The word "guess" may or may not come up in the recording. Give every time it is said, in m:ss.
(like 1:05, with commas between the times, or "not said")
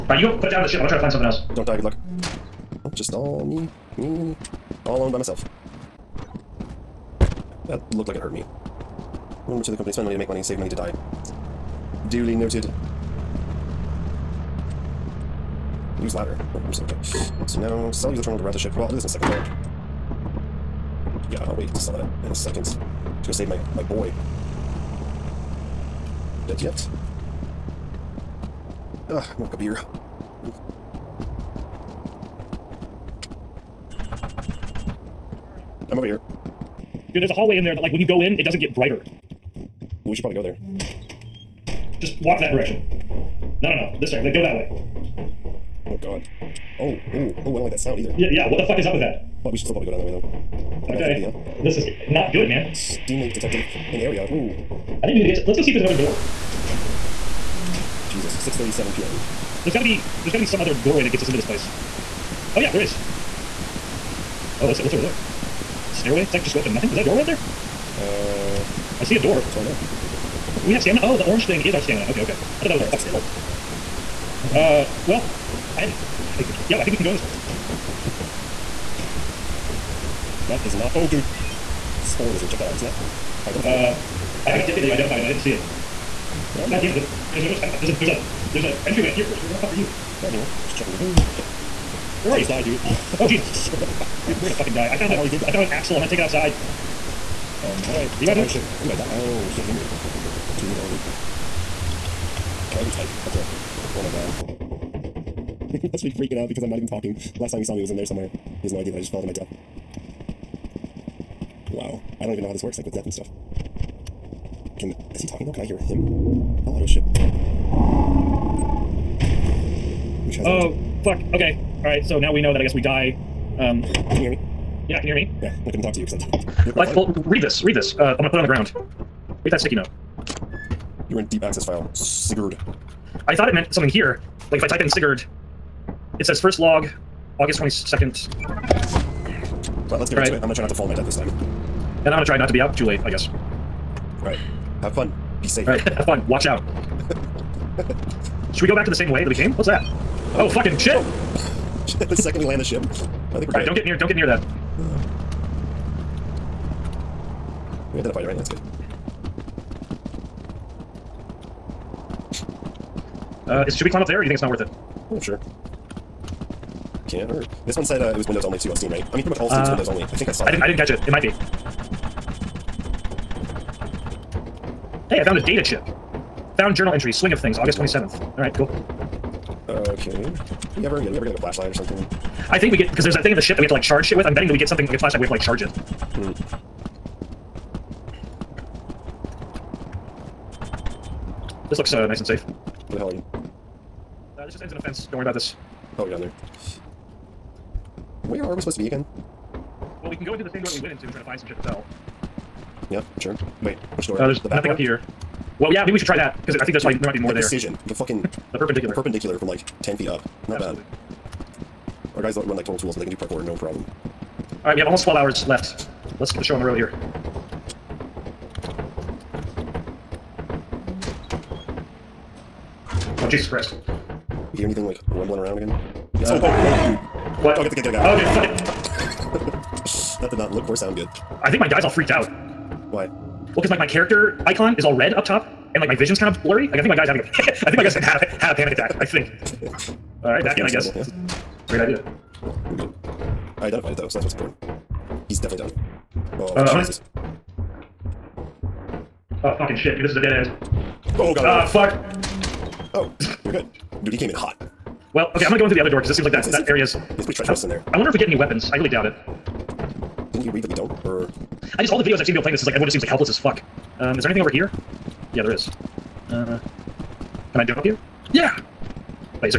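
2:02, 2:23, 4:00.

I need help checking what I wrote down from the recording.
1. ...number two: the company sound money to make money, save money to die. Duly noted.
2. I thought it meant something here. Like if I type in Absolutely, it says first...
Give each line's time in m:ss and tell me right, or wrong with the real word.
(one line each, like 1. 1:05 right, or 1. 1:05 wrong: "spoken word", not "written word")
1. 0:09 wrong: "spend", not "sound"
2. 2:13 wrong: "Sigurd", not "Absolutely".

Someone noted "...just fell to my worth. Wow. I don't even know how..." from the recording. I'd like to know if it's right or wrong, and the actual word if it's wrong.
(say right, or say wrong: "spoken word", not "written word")
wrong: "death", not "worth".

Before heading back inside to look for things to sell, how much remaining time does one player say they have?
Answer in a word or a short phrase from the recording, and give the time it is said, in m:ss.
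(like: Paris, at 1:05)
12 hours, at 3:35.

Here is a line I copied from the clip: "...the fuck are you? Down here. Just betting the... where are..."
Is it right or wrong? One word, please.
wrong.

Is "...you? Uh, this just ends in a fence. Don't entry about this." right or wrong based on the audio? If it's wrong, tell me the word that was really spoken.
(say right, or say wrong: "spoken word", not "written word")
wrong: "worry", not "entry".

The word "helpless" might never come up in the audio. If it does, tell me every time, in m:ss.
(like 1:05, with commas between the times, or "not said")
4:23.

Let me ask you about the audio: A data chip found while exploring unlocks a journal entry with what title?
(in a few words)
Swing of things.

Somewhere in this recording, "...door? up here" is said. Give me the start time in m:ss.
3:24.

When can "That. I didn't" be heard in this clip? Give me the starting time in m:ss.
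2:50.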